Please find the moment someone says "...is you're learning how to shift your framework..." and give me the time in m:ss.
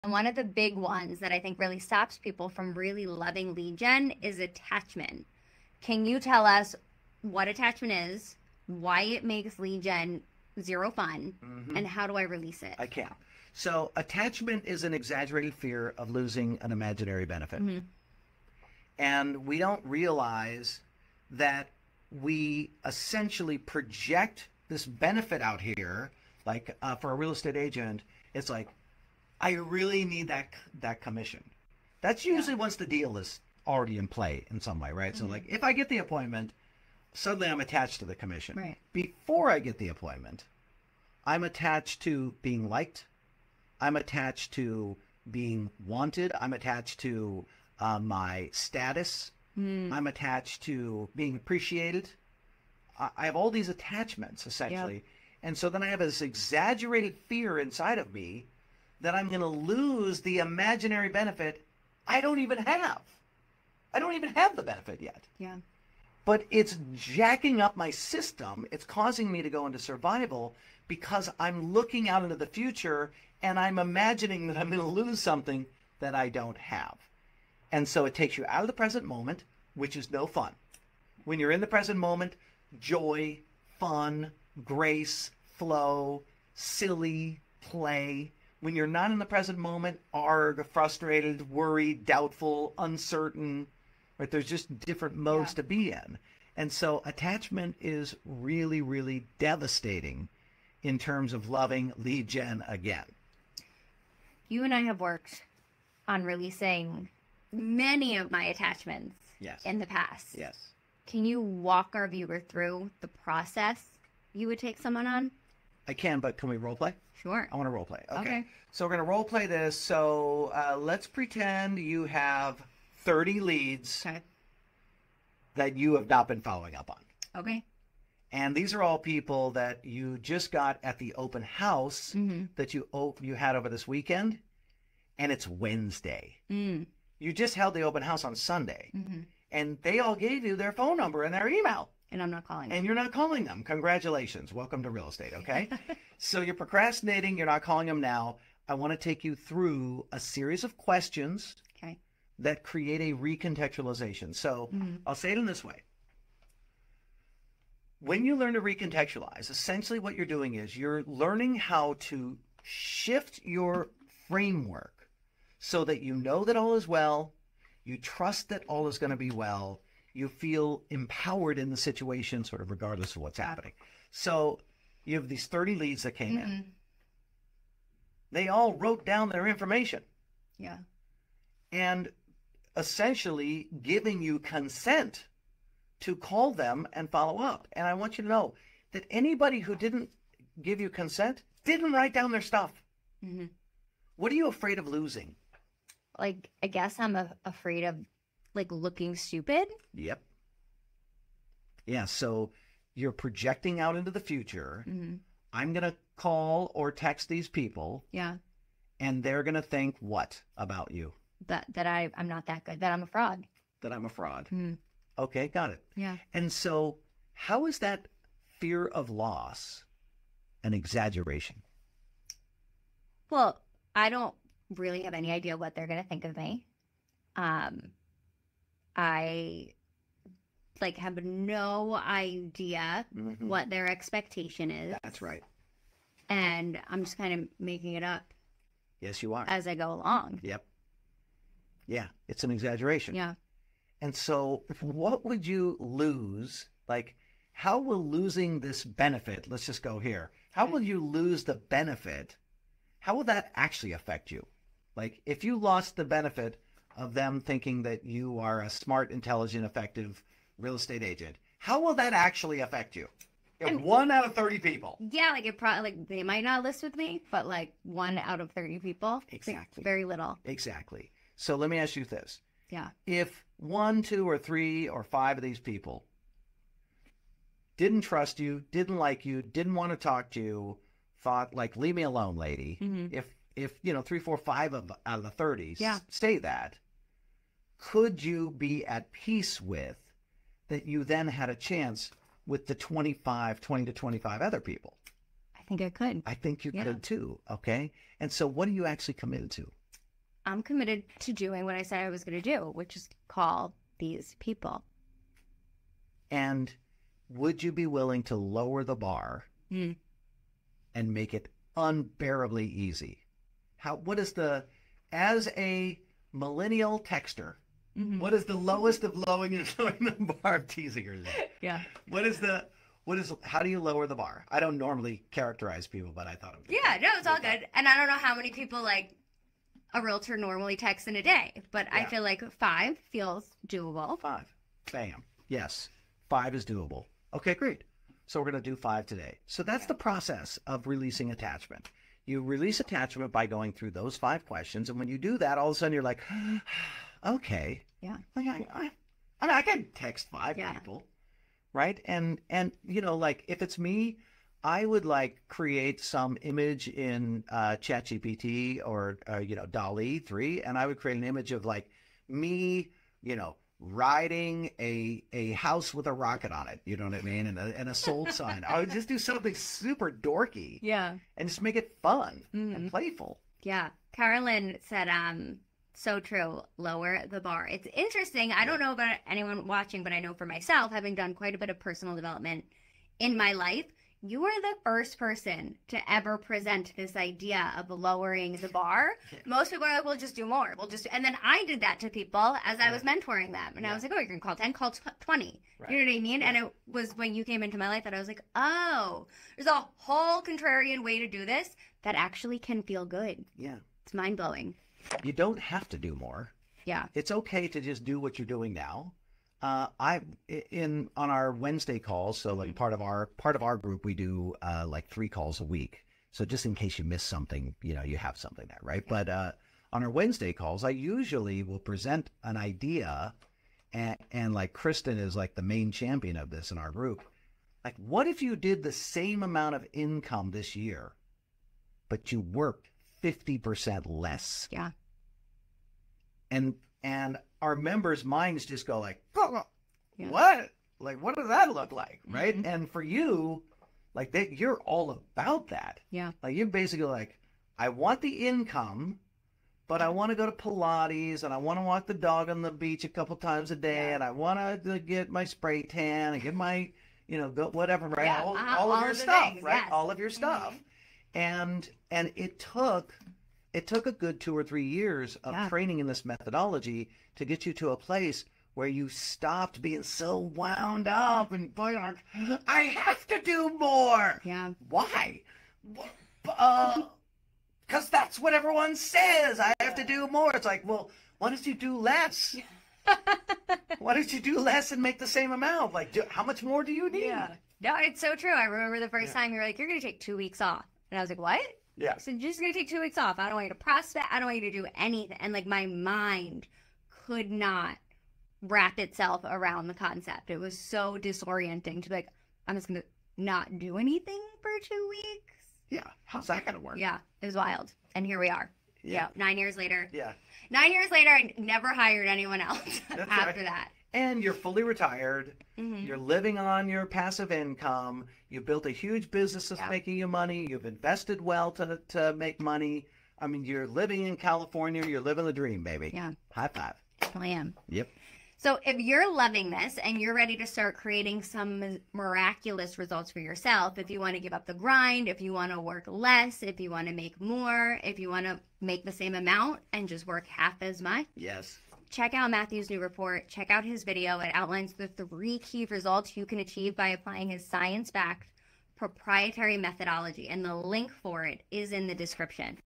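2:40.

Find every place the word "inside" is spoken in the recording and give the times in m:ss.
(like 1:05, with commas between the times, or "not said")
0:57.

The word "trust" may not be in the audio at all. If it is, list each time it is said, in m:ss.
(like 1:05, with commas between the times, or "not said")
2:47, 4:38.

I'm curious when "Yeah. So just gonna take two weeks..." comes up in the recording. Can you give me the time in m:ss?
8:11.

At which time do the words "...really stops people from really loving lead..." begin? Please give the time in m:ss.
0:01.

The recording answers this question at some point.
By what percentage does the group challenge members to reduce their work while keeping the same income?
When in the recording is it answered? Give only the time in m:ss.
7:13.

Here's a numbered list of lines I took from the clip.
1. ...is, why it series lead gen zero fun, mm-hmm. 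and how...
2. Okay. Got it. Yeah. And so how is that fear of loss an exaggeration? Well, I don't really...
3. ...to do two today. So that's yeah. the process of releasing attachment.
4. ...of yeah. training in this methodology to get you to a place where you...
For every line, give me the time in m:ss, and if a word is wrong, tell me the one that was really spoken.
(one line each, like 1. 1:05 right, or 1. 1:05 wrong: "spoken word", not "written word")
1. 0:07 wrong: "makes", not "series"
2. 3:35 right
3. 5:38 wrong: "five", not "two"
4. 7:45 right.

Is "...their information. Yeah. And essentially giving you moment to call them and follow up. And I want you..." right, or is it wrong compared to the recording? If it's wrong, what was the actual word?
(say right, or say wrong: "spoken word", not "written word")
wrong: "consent", not "moment".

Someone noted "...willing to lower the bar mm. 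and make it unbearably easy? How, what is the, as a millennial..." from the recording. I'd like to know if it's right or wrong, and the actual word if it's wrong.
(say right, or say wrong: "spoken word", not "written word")
right.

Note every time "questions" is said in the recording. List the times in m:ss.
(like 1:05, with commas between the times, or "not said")
2:30, 5:44.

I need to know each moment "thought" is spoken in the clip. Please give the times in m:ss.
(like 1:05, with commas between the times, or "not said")
4:41, 5:26.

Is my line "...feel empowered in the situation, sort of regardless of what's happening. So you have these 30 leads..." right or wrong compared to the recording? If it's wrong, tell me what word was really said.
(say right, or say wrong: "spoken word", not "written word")
right.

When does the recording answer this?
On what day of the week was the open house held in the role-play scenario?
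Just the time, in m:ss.
2:18.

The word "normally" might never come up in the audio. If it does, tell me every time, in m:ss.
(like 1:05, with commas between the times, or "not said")
5:24, 5:30.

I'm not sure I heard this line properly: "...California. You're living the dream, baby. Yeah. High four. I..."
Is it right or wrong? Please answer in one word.
wrong.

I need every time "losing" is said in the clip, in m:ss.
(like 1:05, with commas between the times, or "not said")
0:16, 3:14, 4:08.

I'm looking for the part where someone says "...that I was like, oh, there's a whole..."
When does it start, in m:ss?
6:38.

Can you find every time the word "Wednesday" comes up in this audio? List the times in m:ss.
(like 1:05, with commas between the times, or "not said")
2:15, 6:51, 7:00.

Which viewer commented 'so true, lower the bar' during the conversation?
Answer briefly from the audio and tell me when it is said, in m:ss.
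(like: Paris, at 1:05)
Carolyn, at 6:14.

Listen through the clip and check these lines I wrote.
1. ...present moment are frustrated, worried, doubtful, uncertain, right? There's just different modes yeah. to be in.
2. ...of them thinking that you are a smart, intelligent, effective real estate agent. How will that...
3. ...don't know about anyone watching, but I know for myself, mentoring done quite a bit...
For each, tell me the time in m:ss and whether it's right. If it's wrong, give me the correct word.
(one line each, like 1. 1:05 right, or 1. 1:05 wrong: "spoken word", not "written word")
1. 1:29 right
2. 4:16 right
3. 6:18 wrong: "having", not "mentoring".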